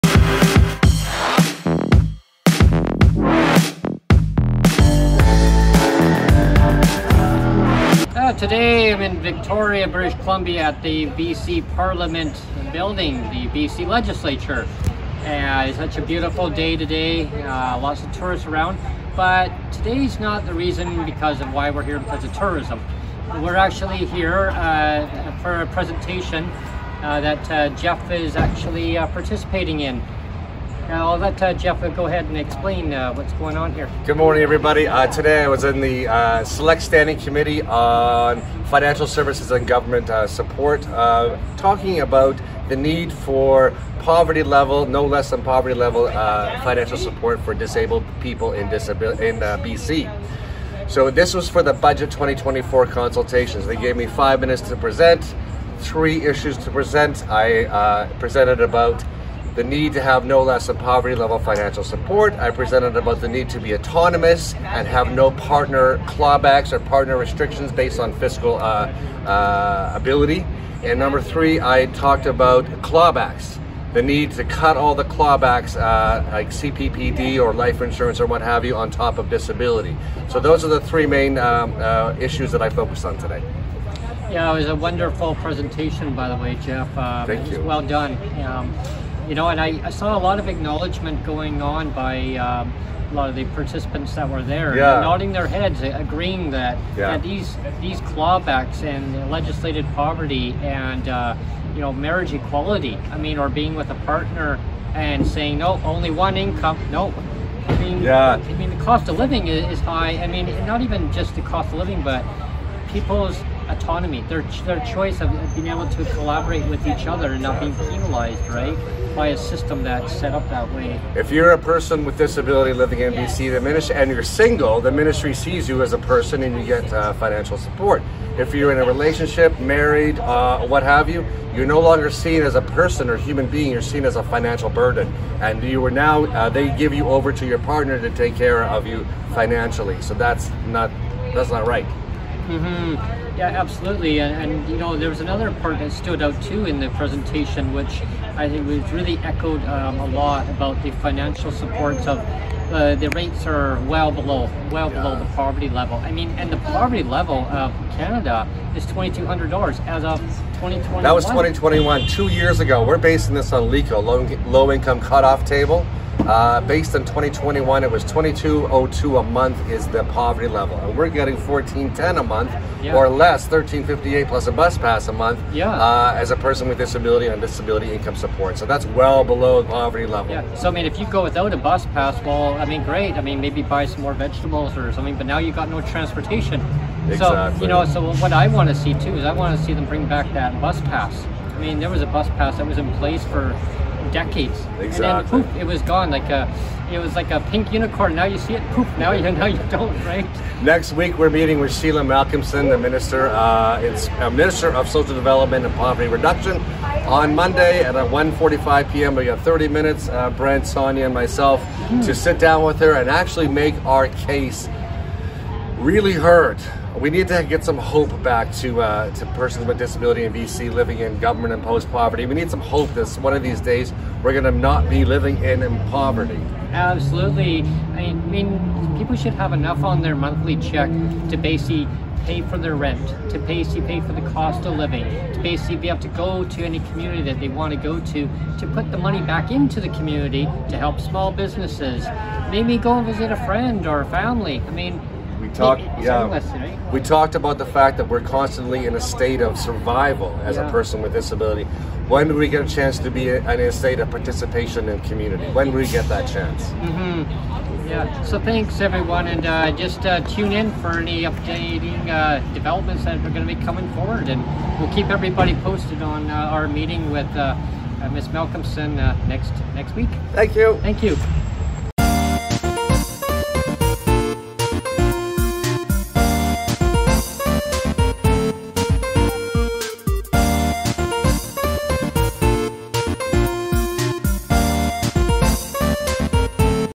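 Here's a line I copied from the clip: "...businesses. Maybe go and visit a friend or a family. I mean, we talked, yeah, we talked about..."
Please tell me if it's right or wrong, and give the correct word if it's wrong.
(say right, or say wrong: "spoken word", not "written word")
right.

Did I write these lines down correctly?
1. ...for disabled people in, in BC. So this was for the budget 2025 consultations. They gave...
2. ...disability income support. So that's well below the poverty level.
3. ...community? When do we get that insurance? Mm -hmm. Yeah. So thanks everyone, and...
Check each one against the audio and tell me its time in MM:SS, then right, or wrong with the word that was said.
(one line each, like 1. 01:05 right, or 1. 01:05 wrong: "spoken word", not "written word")
1. 00:47 wrong: "2024", not "2025"
2. 02:57 right
3. 04:15 wrong: "chance", not "insurance".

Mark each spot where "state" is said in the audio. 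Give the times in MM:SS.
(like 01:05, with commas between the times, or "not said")
04:09, 04:13.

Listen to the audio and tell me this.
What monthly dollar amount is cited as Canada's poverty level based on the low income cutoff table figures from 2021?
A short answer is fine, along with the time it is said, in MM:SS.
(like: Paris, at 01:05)
2202, at 02:48.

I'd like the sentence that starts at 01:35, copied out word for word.
nodding their heads, agreeing that, yeah.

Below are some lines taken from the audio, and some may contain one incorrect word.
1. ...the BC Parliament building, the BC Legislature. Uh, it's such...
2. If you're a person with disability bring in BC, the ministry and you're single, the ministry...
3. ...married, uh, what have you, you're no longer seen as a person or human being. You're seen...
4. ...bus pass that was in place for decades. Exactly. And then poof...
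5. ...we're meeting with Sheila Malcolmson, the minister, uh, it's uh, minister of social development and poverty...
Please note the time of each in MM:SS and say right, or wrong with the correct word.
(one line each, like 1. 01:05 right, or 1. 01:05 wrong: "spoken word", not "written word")
1. 00:10 right
2. 02:01 wrong: "living", not "bring"
3. 02:09 right
4. 03:12 right
5. 03:21 right.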